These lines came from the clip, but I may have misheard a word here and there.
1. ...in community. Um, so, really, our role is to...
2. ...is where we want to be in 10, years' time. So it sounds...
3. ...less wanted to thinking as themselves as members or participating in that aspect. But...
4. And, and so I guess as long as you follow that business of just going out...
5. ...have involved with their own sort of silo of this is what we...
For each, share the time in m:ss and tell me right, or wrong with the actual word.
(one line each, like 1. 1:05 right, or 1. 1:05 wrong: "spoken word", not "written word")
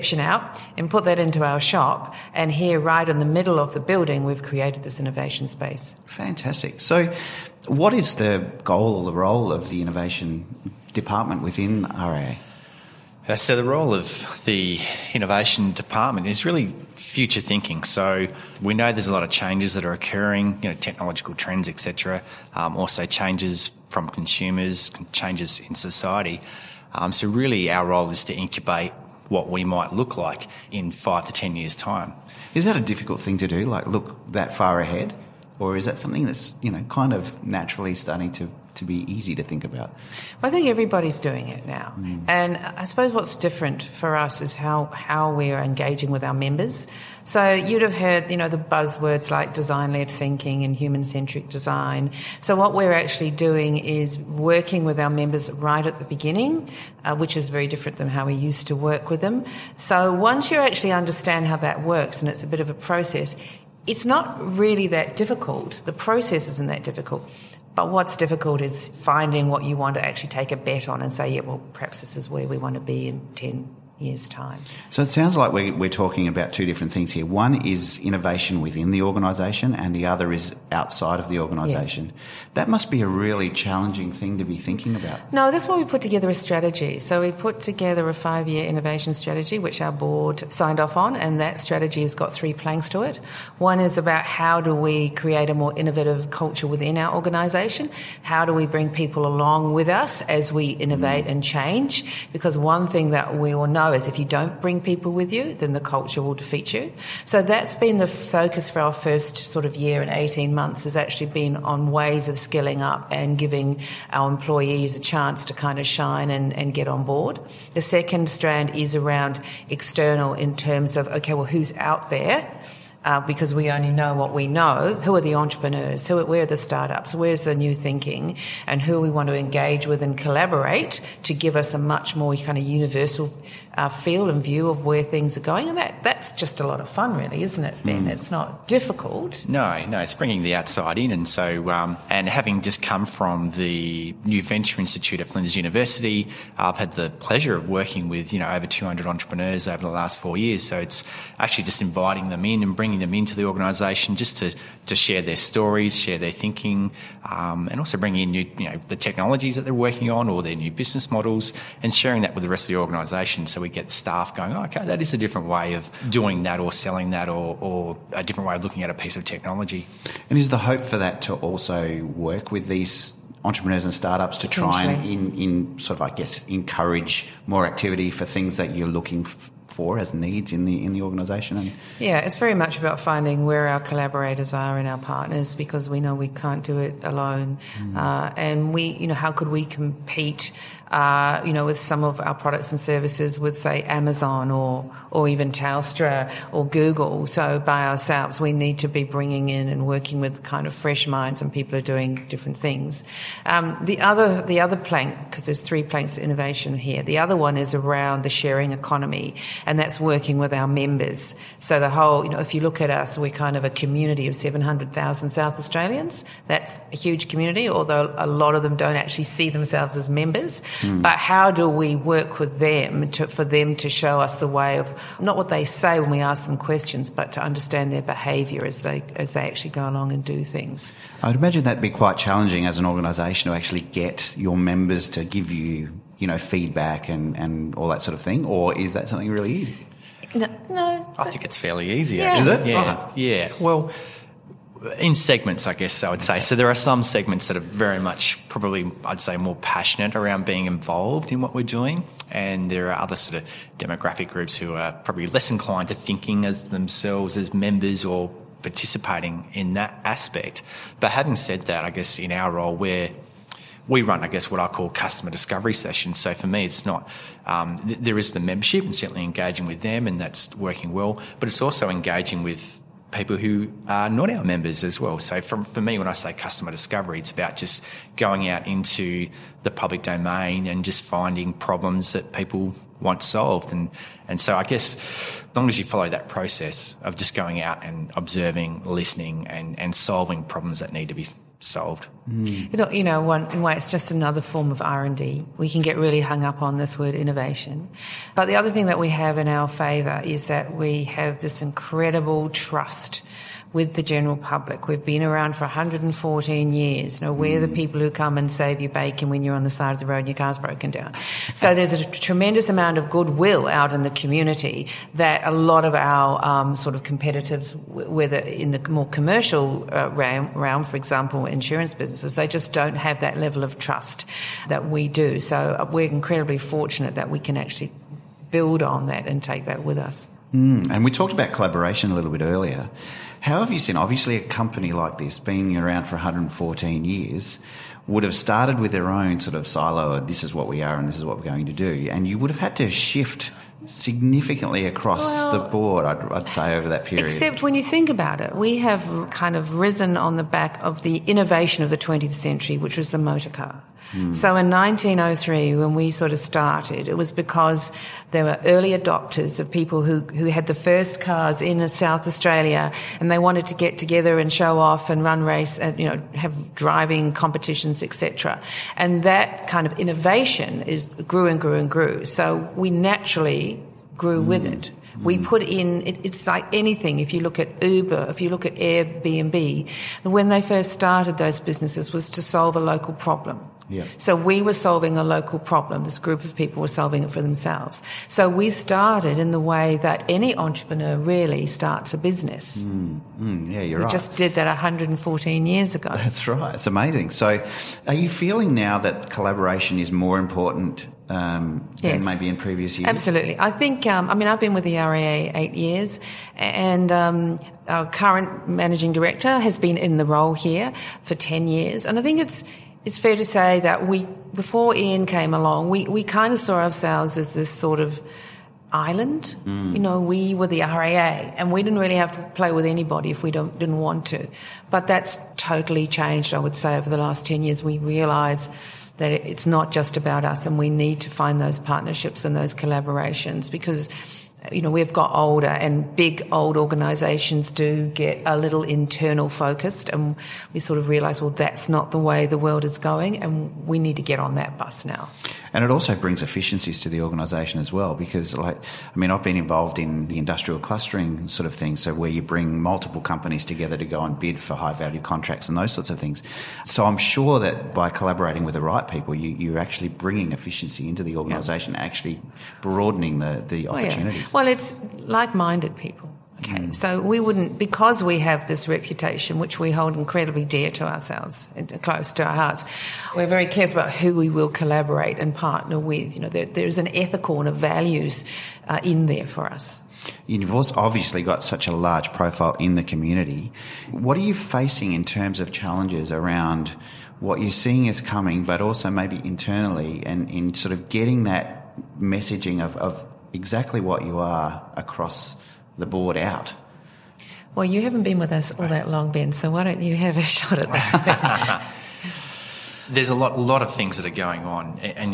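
1. 0:25 wrong: "society", not "community"
2. 1:12 right
3. 4:15 wrong: "inclined", not "wanted"
4. 4:43 wrong: "process", not "business"
5. 5:38 wrong: "started", not "involved".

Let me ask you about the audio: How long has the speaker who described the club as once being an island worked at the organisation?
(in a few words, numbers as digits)
8 years.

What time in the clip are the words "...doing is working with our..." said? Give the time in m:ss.
0:53.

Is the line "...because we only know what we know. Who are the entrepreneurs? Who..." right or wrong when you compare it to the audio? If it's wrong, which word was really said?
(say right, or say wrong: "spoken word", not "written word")
right.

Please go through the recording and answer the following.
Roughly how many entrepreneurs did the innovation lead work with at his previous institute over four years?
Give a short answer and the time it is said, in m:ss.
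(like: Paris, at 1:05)
200, at 2:28.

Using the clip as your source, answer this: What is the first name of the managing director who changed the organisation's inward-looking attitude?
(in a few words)
Ian.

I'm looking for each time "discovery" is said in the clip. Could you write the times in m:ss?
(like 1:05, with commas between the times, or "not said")
4:25, 4:36.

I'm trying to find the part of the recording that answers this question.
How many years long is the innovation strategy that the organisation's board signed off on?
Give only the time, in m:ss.
1:28.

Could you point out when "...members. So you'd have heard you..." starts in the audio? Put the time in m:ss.
0:46.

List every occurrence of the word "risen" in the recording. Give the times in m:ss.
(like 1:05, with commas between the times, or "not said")
5:49.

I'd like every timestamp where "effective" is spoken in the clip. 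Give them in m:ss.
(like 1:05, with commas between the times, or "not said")
not said.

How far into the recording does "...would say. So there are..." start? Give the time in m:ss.
4:06.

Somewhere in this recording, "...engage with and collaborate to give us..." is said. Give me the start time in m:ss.
2:09.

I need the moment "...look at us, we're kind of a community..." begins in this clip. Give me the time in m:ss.
3:32.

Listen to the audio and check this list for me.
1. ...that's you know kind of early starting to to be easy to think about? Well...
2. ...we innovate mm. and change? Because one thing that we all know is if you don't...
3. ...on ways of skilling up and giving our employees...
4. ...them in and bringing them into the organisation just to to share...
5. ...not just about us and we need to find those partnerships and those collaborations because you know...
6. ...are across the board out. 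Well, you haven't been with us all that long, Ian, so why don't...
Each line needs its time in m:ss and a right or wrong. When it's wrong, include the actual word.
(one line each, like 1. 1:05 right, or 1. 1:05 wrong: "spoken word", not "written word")
1. 0:36 wrong: "naturally", not "early"
2. 1:40 right
3. 1:51 right
4. 2:32 right
5. 7:09 right
6. 8:14 wrong: "Ben", not "Ian".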